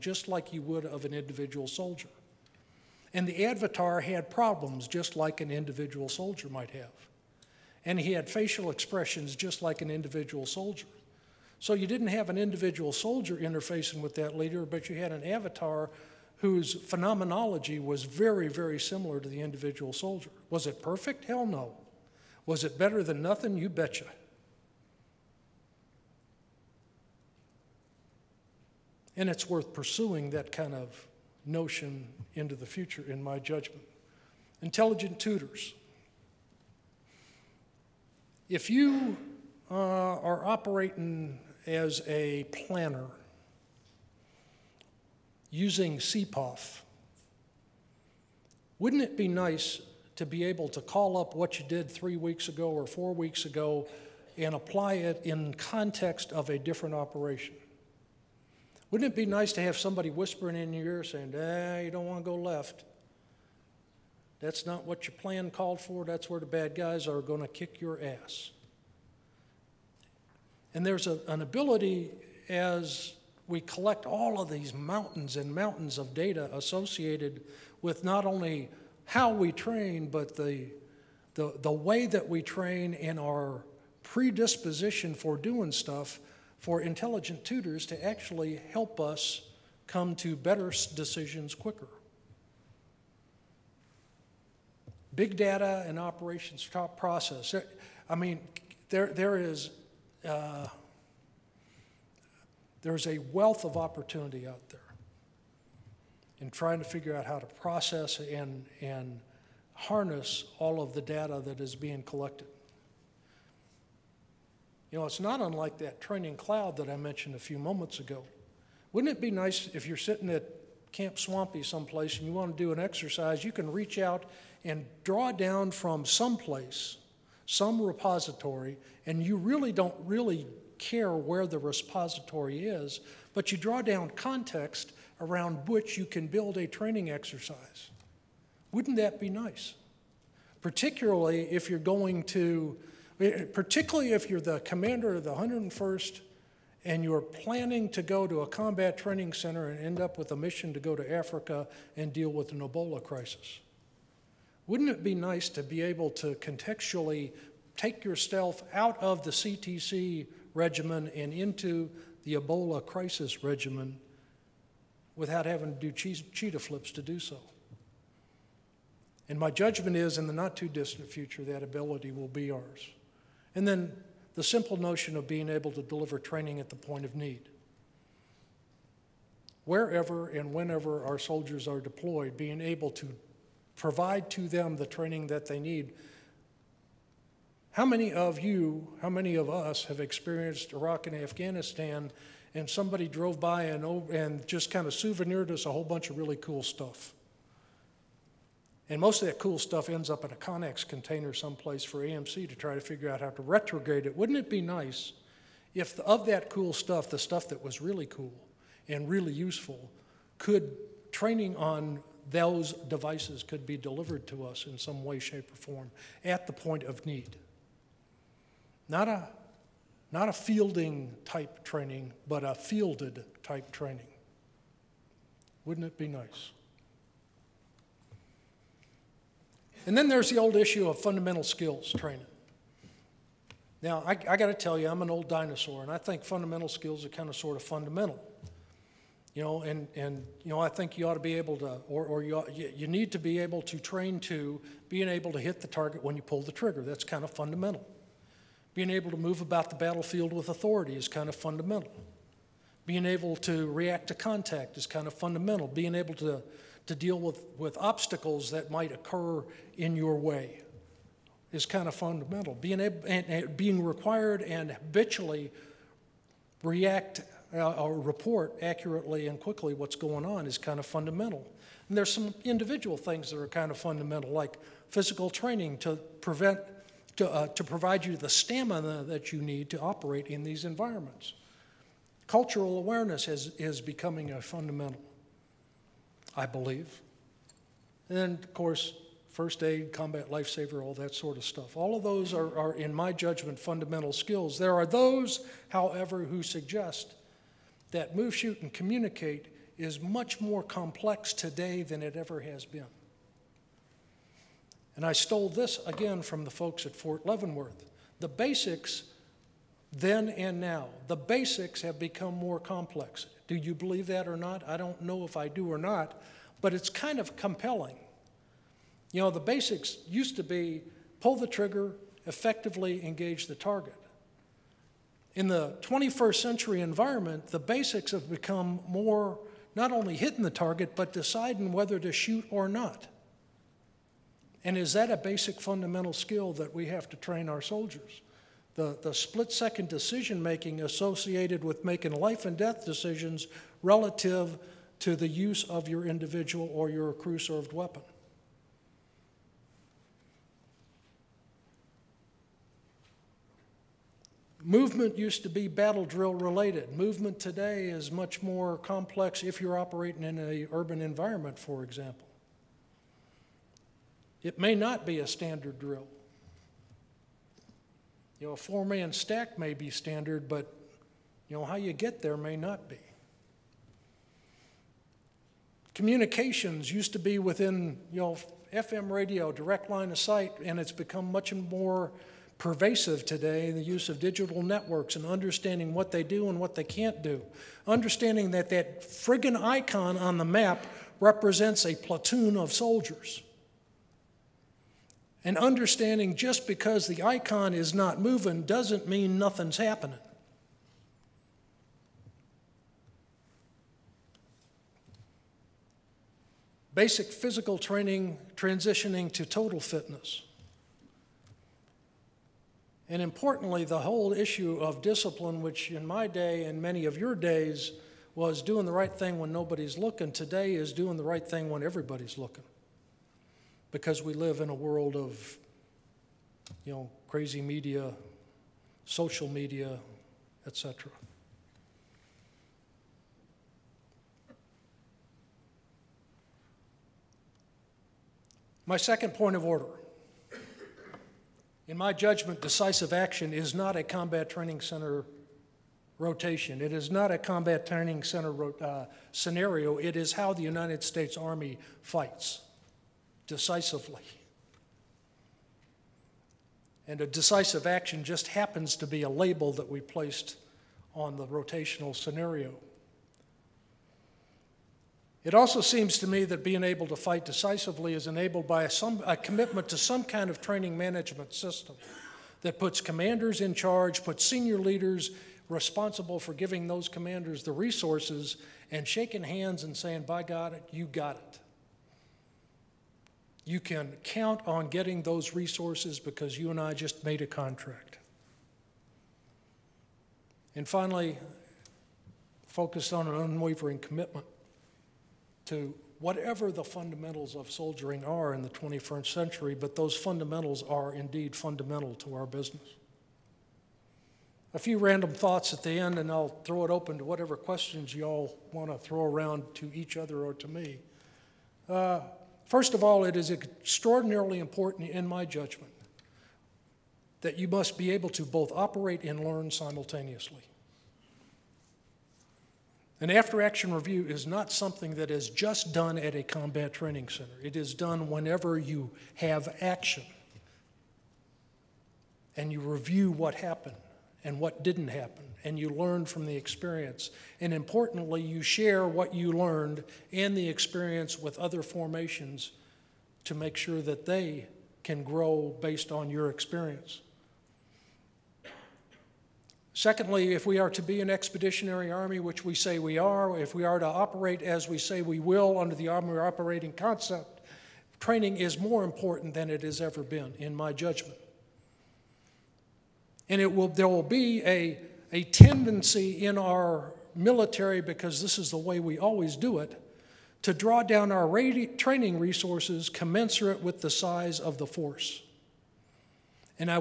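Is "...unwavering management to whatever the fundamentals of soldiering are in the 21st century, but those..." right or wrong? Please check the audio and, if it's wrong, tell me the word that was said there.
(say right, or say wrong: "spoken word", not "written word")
wrong: "commitment", not "management".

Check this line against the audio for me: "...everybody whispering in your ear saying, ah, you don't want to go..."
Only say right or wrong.
wrong.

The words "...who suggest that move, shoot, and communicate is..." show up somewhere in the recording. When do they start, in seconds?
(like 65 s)
296 s.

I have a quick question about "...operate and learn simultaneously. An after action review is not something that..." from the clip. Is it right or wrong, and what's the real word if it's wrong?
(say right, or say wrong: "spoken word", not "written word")
right.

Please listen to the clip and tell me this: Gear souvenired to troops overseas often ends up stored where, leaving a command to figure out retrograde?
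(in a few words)
Connex container.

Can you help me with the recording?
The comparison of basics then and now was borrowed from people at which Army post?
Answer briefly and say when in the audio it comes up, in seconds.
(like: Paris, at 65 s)
Fort Leavenworth, at 306 s.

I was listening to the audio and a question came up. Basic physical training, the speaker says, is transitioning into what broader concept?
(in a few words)
total fitness.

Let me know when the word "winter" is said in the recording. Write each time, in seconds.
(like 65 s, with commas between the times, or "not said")
not said.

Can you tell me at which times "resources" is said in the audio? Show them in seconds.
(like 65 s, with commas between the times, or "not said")
477 s, 485 s, 572 s.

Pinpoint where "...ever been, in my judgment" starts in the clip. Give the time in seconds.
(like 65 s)
560 s.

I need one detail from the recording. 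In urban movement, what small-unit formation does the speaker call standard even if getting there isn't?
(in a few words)
four-man stack.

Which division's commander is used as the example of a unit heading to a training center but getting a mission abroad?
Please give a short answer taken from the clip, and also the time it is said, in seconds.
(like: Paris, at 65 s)
101st, at 145 s.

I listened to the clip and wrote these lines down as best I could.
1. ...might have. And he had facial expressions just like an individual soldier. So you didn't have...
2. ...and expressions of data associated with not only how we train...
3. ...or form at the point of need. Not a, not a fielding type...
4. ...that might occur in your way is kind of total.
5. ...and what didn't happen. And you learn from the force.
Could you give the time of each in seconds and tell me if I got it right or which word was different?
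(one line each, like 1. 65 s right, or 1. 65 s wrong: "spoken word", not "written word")
1. 6 s right
2. 75 s wrong: "mountains", not "expressions"
3. 215 s right
4. 258 s wrong: "fundamental", not "total"
5. 534 s wrong: "experience", not "force".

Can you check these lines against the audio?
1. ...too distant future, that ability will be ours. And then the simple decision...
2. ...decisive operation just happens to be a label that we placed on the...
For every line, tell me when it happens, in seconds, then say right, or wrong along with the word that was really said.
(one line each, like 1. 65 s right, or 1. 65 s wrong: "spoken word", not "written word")
1. 170 s wrong: "notion", not "decision"
2. 457 s wrong: "action", not "operation".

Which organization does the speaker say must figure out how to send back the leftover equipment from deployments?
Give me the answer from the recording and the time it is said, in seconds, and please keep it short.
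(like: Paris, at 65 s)
AMC, at 202 s.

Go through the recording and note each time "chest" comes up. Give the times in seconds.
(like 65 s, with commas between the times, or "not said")
not said.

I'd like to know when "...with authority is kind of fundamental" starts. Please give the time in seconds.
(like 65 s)
250 s.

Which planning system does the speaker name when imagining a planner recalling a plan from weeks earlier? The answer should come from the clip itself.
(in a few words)
CPOF.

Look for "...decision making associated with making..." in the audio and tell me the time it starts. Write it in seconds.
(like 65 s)
339 s.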